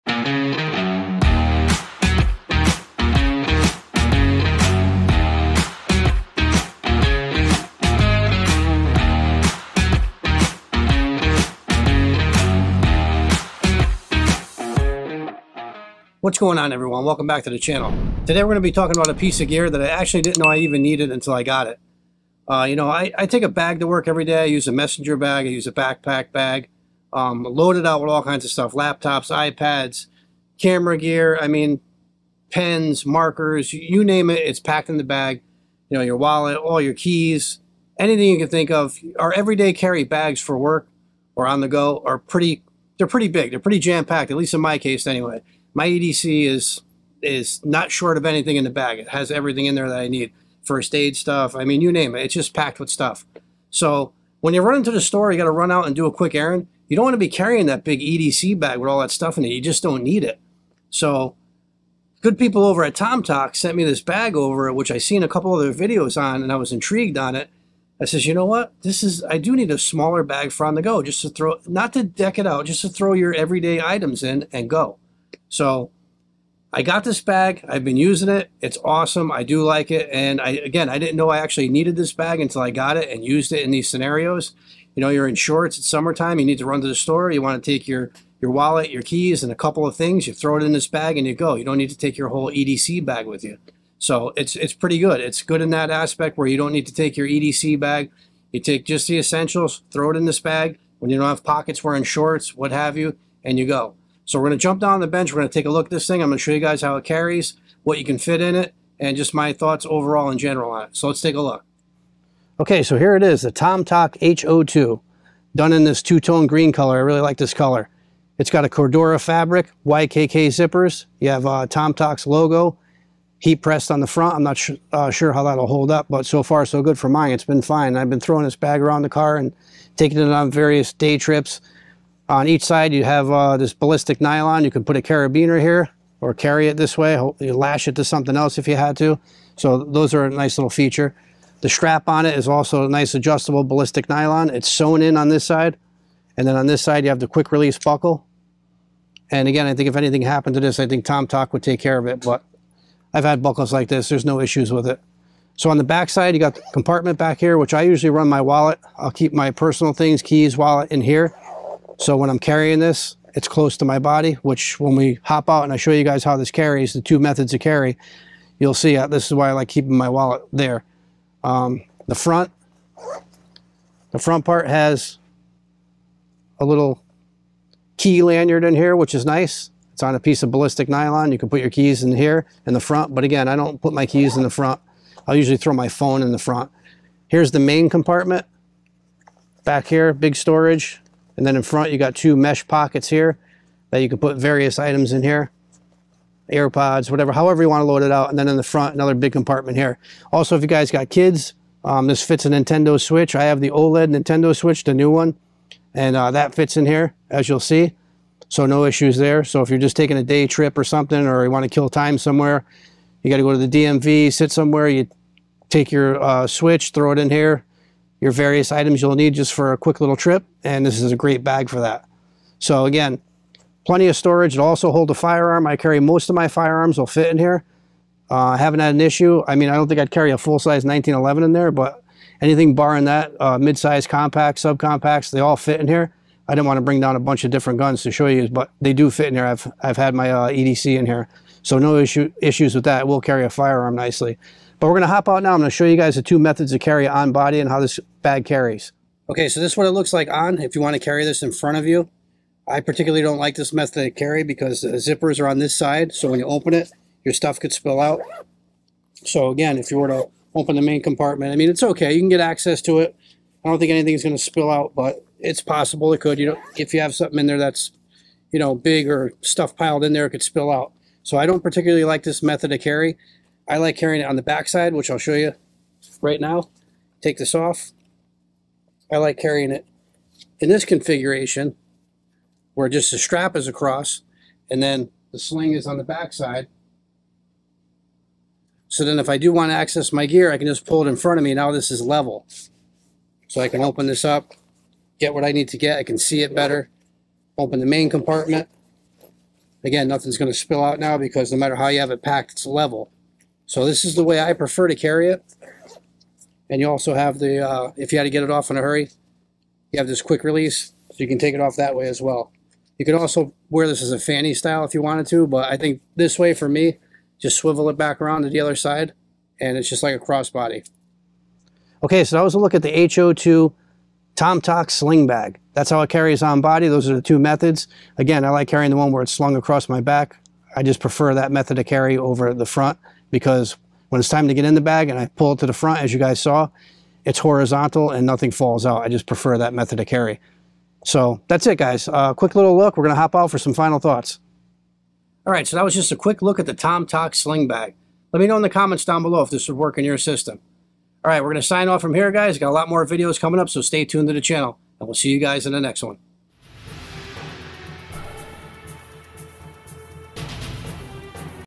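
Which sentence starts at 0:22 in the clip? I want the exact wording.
Uh, you know, I, I, take a bag to work every day.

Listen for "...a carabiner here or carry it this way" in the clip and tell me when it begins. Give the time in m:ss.
2:14.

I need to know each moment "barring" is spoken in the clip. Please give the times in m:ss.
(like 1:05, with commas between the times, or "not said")
3:52.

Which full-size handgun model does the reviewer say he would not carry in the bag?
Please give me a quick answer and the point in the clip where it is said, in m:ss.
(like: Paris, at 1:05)
1911, at 3:50.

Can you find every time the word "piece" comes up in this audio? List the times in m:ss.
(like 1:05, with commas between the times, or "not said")
0:19, 3:00.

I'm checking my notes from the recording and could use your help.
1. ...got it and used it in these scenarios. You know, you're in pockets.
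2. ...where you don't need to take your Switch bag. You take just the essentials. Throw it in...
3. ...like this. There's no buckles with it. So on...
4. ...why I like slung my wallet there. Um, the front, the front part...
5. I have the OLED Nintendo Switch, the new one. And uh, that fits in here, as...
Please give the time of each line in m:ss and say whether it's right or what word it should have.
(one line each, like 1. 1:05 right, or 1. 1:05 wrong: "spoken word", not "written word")
1. 1:22 wrong: "shorts", not "pockets"
2. 1:36 wrong: "EDC", not "Switch"
3. 2:33 wrong: "issues", not "buckles"
4. 2:49 wrong: "keeping", not "slung"
5. 3:23 right.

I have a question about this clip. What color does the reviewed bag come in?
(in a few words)
green.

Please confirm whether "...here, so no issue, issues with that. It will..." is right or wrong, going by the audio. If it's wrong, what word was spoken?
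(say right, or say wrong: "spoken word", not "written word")
right.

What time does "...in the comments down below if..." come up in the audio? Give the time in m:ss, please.
5:48.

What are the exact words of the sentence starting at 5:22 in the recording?
Okay, so that was a look at the HO2 TomToc sling bag.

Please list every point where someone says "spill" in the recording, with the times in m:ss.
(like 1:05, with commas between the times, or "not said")
4:17, 4:24, 4:30, 5:00.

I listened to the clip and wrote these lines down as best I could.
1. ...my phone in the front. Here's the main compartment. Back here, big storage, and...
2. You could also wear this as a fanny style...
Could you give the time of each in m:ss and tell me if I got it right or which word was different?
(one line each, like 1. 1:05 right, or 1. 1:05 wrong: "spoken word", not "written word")
1. 3:05 right
2. 5:12 right.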